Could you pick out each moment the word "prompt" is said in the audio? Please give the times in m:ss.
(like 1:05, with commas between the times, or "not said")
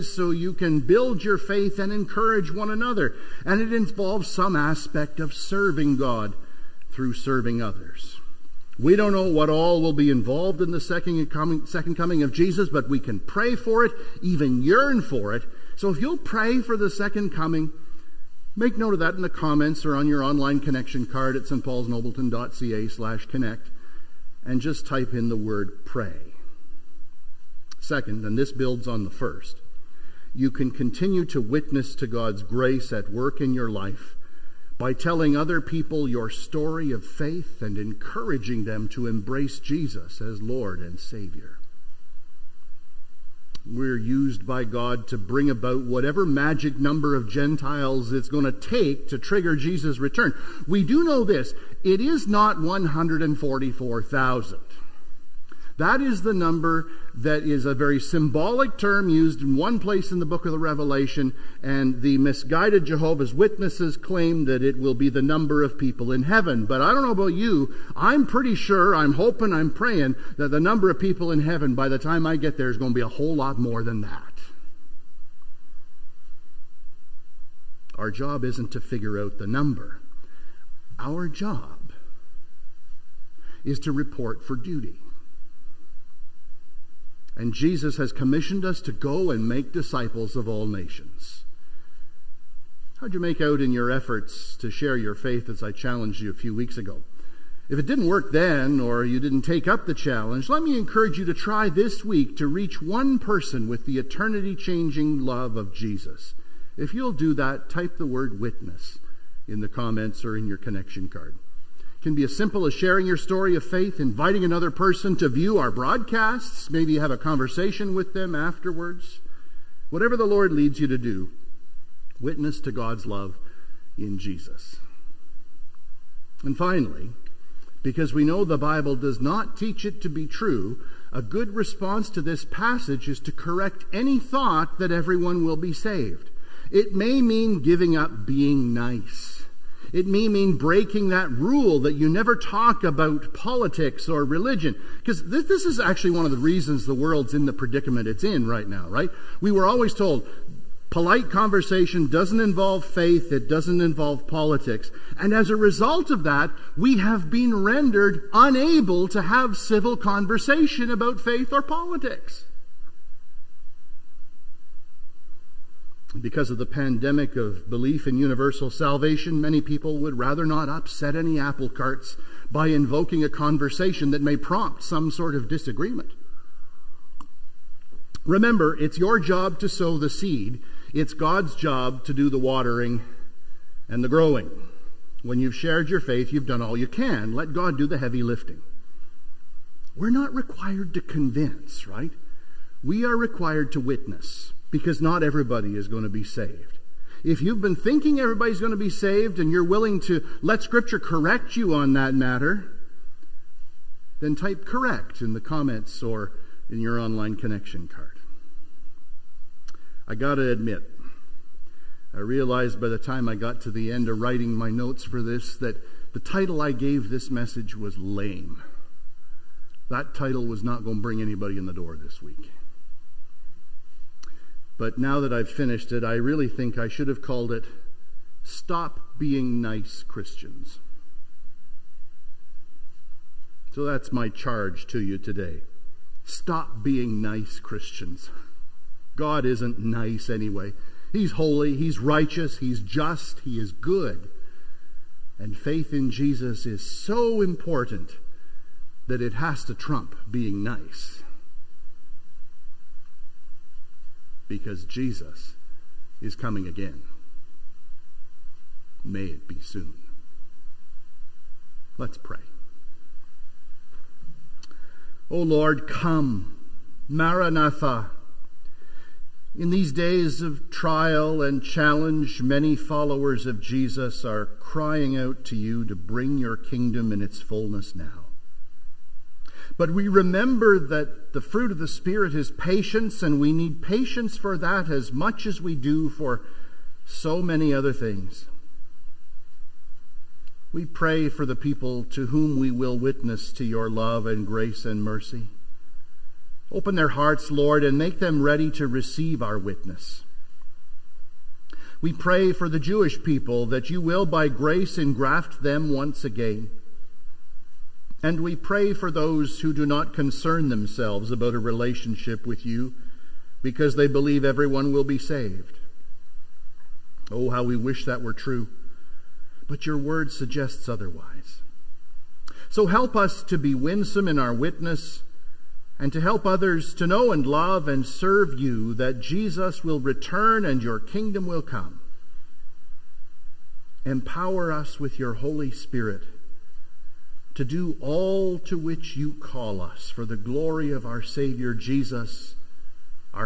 2:54.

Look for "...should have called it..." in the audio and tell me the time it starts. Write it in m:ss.
3:46.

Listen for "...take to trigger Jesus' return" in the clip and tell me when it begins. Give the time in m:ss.
0:48.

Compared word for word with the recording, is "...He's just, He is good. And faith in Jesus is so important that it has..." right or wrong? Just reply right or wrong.
right.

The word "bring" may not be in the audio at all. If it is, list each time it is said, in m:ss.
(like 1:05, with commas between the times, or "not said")
0:45, 3:41, 4:35.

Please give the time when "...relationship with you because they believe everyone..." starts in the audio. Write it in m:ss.
5:11.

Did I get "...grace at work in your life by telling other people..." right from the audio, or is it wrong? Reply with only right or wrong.
right.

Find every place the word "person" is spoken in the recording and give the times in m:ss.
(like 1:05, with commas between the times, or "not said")
1:43, 1:54.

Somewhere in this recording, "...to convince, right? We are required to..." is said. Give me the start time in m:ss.
3:10.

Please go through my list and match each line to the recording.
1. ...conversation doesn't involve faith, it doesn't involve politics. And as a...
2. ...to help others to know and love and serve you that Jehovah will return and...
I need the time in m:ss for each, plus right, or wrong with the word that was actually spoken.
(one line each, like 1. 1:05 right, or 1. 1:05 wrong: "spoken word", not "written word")
1. 2:31 right
2. 5:26 wrong: "Jesus", not "Jehovah".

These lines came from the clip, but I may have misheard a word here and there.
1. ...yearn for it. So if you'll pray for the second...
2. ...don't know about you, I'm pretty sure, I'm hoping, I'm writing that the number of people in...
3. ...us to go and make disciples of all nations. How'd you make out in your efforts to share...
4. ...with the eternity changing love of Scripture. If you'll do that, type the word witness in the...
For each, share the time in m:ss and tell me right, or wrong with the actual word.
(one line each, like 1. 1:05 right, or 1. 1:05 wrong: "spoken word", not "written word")
1. 0:14 right
2. 1:06 wrong: "praying", not "writing"
3. 1:28 right
4. 1:43 wrong: "Jesus", not "Scripture".